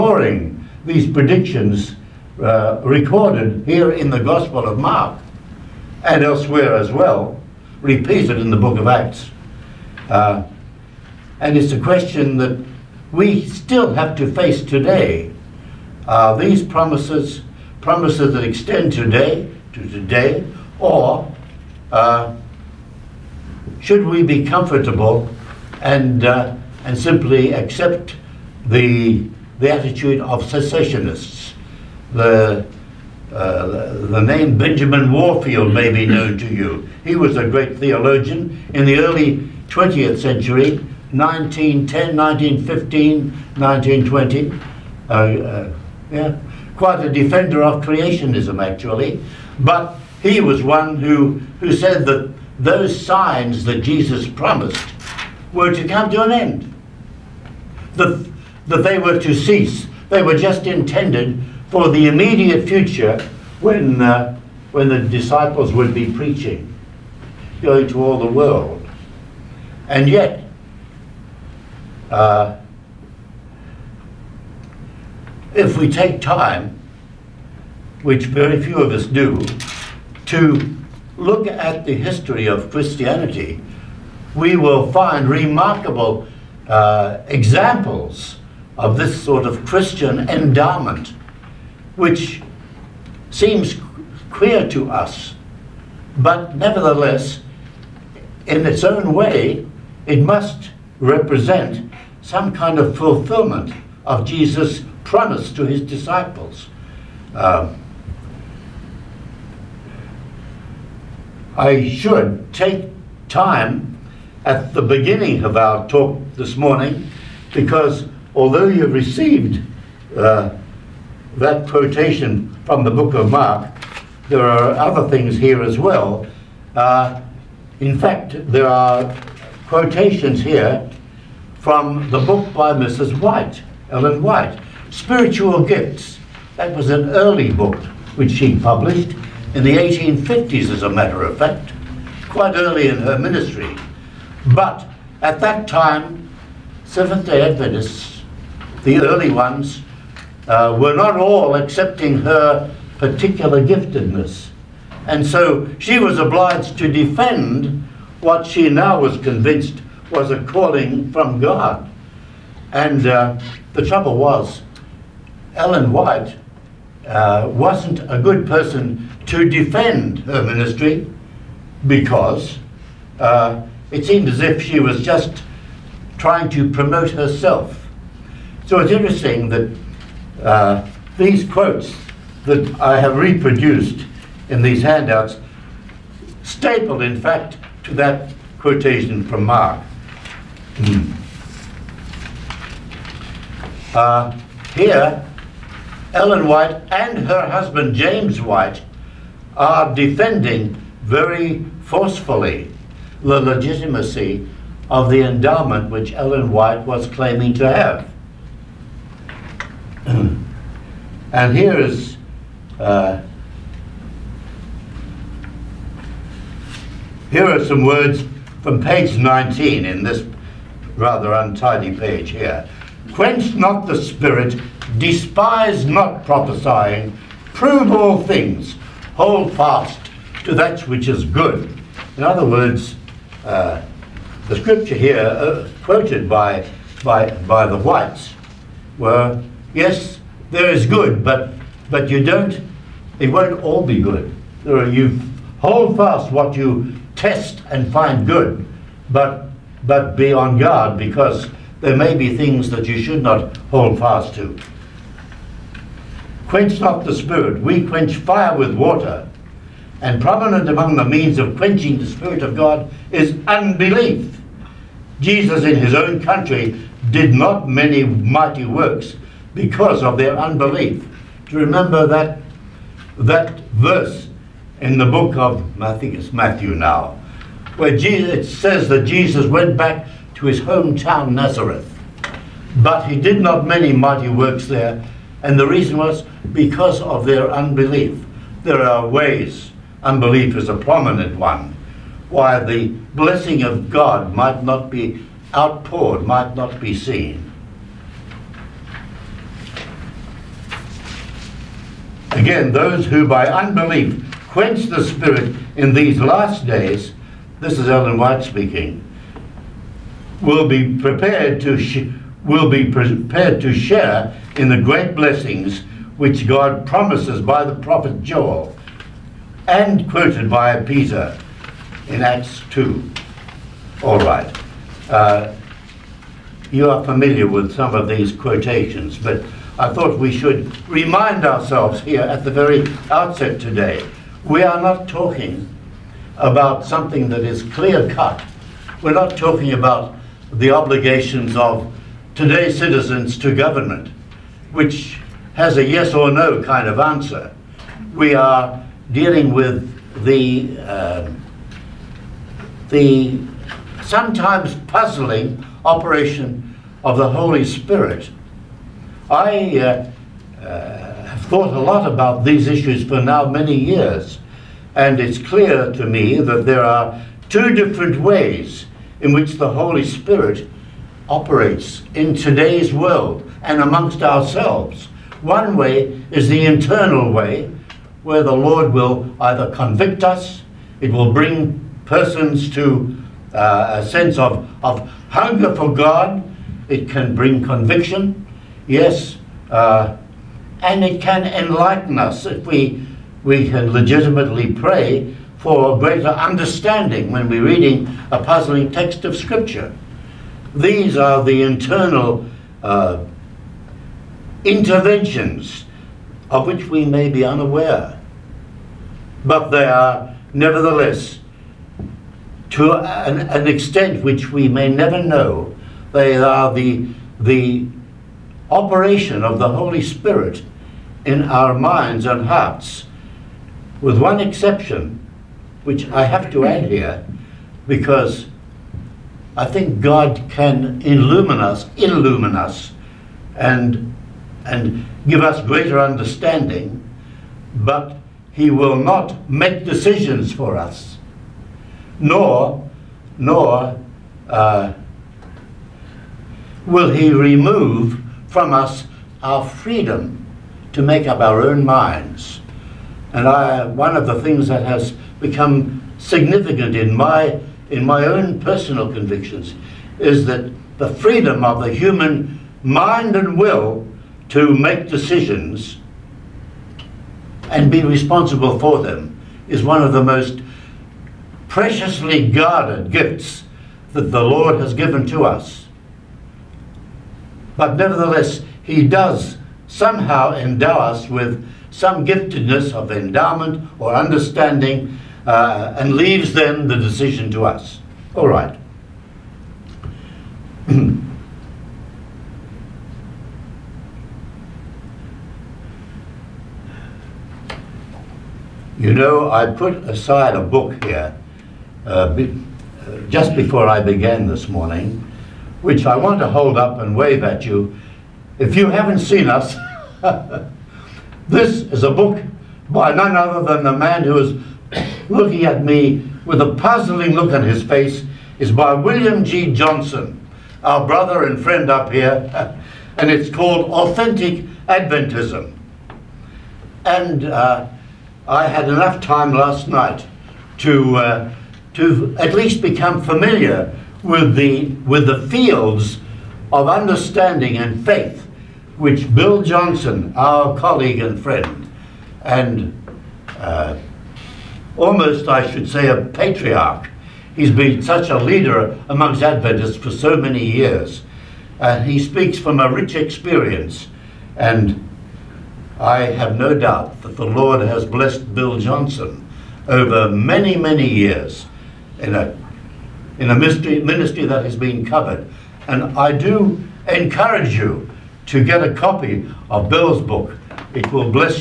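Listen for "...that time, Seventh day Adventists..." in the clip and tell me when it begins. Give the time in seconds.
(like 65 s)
145 s.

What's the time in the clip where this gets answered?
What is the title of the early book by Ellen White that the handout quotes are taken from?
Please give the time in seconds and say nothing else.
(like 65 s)
134 s.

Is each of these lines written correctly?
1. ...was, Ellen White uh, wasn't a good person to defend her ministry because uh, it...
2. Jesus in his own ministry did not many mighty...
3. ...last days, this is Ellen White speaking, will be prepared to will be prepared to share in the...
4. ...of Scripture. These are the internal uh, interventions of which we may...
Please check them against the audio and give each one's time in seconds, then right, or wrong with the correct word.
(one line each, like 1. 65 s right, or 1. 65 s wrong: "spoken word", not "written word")
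1. 164 s right
2. 265 s wrong: "country", not "ministry"
3. 306 s right
4. 399 s right.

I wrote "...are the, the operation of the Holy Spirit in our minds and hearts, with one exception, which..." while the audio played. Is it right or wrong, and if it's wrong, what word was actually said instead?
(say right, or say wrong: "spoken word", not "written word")
right.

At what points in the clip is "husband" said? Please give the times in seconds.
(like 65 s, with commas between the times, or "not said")
197 s.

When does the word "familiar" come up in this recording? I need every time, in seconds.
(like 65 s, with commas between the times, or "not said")
327 s, 533 s.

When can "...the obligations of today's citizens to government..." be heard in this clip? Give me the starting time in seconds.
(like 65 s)
340 s.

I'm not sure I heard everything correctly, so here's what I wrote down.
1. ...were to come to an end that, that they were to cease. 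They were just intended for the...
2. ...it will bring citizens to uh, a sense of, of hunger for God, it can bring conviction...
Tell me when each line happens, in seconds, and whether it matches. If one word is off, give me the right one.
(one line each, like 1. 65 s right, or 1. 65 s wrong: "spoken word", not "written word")
1. 55 s right
2. 380 s wrong: "persons", not "citizens".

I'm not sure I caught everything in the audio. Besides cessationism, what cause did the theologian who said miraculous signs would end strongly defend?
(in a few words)
Creationism.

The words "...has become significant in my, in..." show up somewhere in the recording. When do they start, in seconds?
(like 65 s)
454 s.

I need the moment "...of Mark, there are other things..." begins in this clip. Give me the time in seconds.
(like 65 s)
123 s.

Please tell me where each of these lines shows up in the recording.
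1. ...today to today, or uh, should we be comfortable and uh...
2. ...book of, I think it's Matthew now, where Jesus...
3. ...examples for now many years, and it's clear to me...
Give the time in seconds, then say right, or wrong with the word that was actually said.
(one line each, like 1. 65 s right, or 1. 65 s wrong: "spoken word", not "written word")
1. 18 s right
2. 275 s right
3. 362 s wrong: "issues", not "examples".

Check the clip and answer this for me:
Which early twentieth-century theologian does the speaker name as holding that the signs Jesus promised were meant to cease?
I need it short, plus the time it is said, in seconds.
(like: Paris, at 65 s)
Benjamin Warfield, at 34 s.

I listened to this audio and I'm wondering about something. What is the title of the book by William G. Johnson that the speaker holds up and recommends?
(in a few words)
Authentic Adventism.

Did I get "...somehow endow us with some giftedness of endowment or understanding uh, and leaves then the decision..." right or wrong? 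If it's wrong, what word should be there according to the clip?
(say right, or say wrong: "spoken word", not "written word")
right.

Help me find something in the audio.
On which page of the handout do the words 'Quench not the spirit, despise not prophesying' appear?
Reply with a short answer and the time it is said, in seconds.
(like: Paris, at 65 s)
19, at 218 s.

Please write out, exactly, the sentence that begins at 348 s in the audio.
We are dealing with the um, the sometimes puzzling operation of the Holy Spirit.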